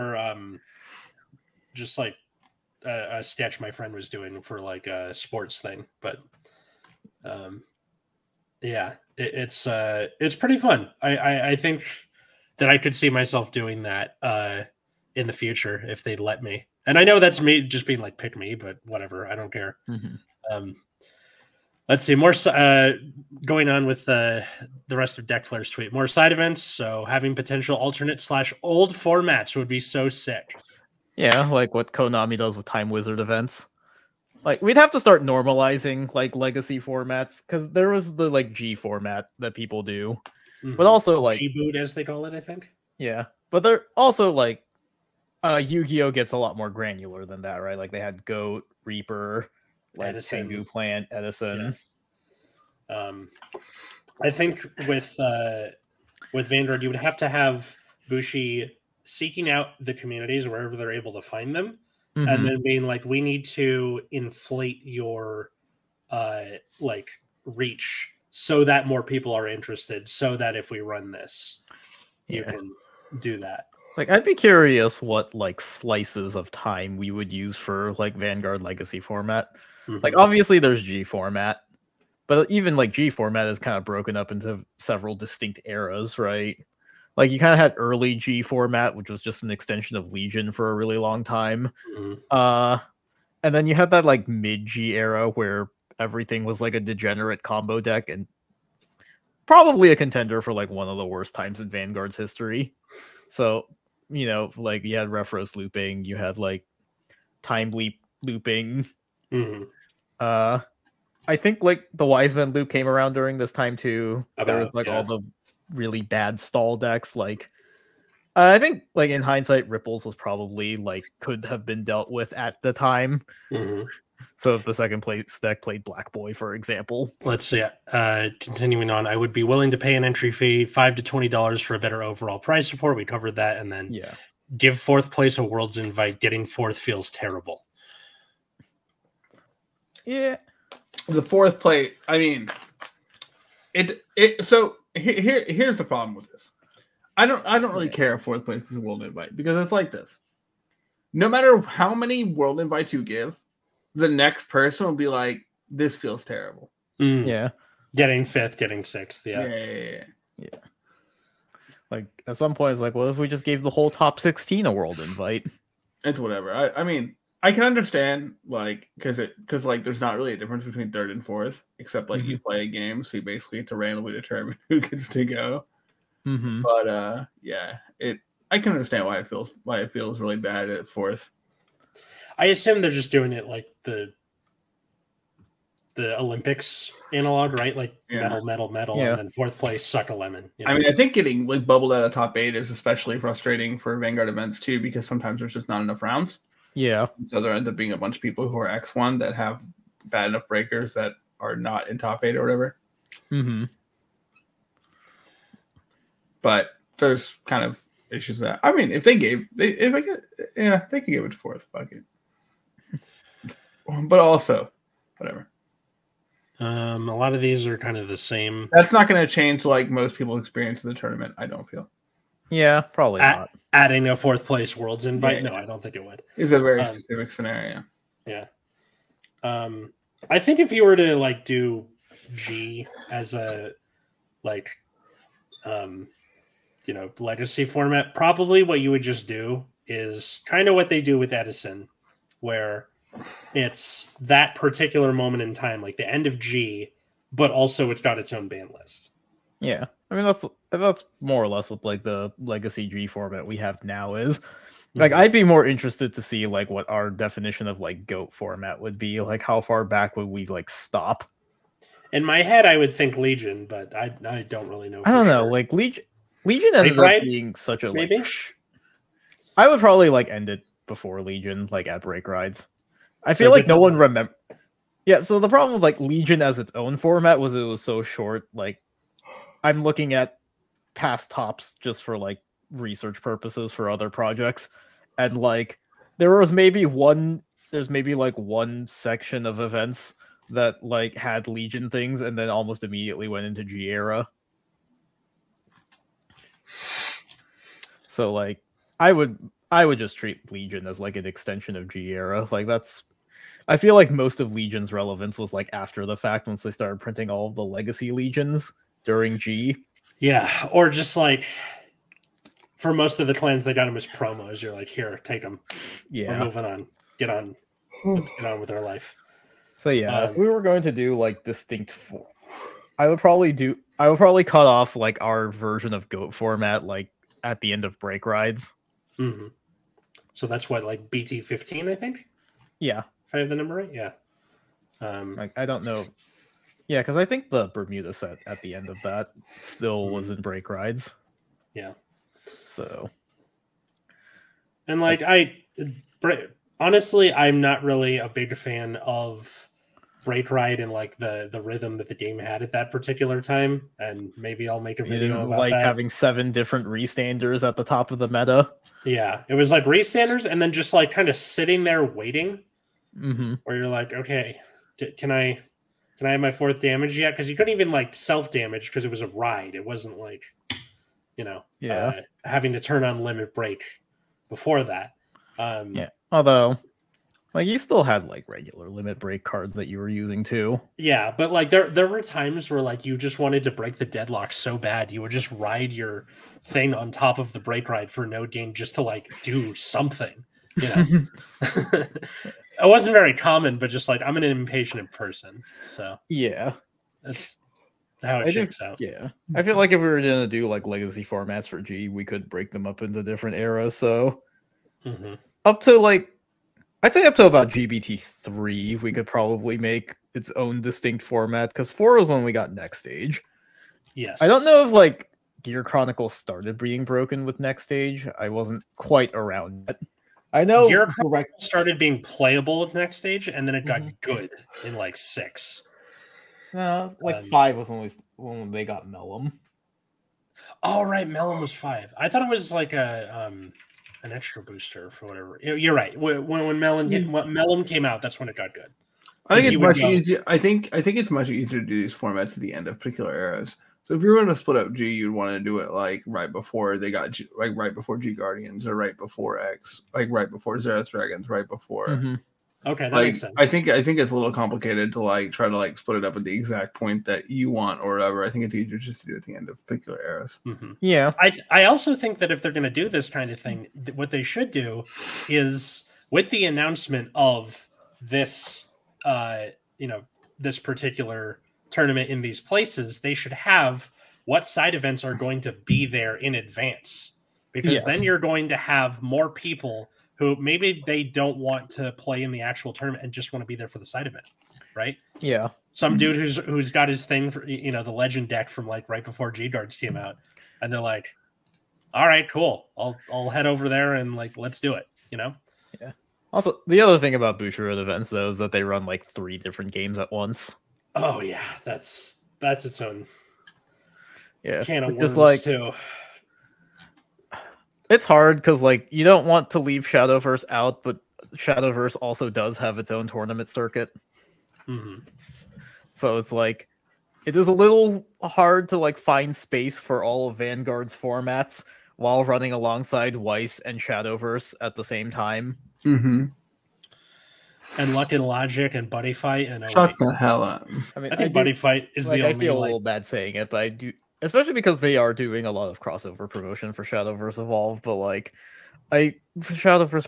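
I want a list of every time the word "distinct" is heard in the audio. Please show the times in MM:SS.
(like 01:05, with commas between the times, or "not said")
01:25, 05:21, 06:50.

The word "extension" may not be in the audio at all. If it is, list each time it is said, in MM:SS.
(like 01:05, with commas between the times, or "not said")
01:29, 05:01.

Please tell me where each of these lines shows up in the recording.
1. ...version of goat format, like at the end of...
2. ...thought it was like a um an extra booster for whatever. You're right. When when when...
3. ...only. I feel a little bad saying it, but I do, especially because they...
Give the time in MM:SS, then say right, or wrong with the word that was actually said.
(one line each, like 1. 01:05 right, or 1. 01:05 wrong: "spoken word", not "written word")
1. 05:25 right
2. 07:12 right
3. 08:52 right.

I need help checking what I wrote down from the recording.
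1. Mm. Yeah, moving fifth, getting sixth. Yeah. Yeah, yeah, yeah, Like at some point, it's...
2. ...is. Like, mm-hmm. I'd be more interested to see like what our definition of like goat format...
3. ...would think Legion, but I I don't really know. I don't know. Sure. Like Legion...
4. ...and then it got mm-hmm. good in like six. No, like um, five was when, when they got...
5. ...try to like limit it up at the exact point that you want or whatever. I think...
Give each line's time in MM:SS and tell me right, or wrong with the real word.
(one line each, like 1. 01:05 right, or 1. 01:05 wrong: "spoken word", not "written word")
1. 02:36 wrong: "getting", not "moving"
2. 04:14 right
3. 04:22 right
4. 07:03 right
5. 07:35 wrong: "split", not "limit".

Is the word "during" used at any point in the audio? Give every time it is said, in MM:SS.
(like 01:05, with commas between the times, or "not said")
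01:53, 05:09.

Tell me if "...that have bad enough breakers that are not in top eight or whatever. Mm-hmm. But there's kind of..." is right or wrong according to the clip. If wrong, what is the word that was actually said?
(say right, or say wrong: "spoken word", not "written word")
right.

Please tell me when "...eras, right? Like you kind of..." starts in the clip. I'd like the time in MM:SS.
01:25.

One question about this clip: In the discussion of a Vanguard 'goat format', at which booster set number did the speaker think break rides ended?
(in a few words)
BT15.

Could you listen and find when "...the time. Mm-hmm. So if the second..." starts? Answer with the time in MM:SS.
02:02.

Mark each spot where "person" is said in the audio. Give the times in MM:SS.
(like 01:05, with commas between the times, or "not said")
02:34, 06:35.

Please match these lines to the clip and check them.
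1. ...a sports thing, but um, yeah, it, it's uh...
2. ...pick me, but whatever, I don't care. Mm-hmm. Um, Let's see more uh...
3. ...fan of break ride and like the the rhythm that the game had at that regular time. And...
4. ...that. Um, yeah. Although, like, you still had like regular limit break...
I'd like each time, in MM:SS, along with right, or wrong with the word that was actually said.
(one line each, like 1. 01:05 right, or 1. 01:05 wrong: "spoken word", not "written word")
1. 00:04 right
2. 00:18 right
3. 05:48 wrong: "particular", not "regular"
4. 06:14 right.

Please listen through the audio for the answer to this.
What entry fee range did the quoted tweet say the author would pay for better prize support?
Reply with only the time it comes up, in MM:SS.
02:10.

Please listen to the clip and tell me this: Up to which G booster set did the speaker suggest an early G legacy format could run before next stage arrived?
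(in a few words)
GBT3.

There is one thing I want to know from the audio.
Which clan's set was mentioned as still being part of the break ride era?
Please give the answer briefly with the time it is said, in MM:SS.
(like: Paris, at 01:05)
Bermuda, at 05:37.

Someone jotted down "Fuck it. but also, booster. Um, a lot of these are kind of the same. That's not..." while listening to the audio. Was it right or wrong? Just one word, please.
wrong.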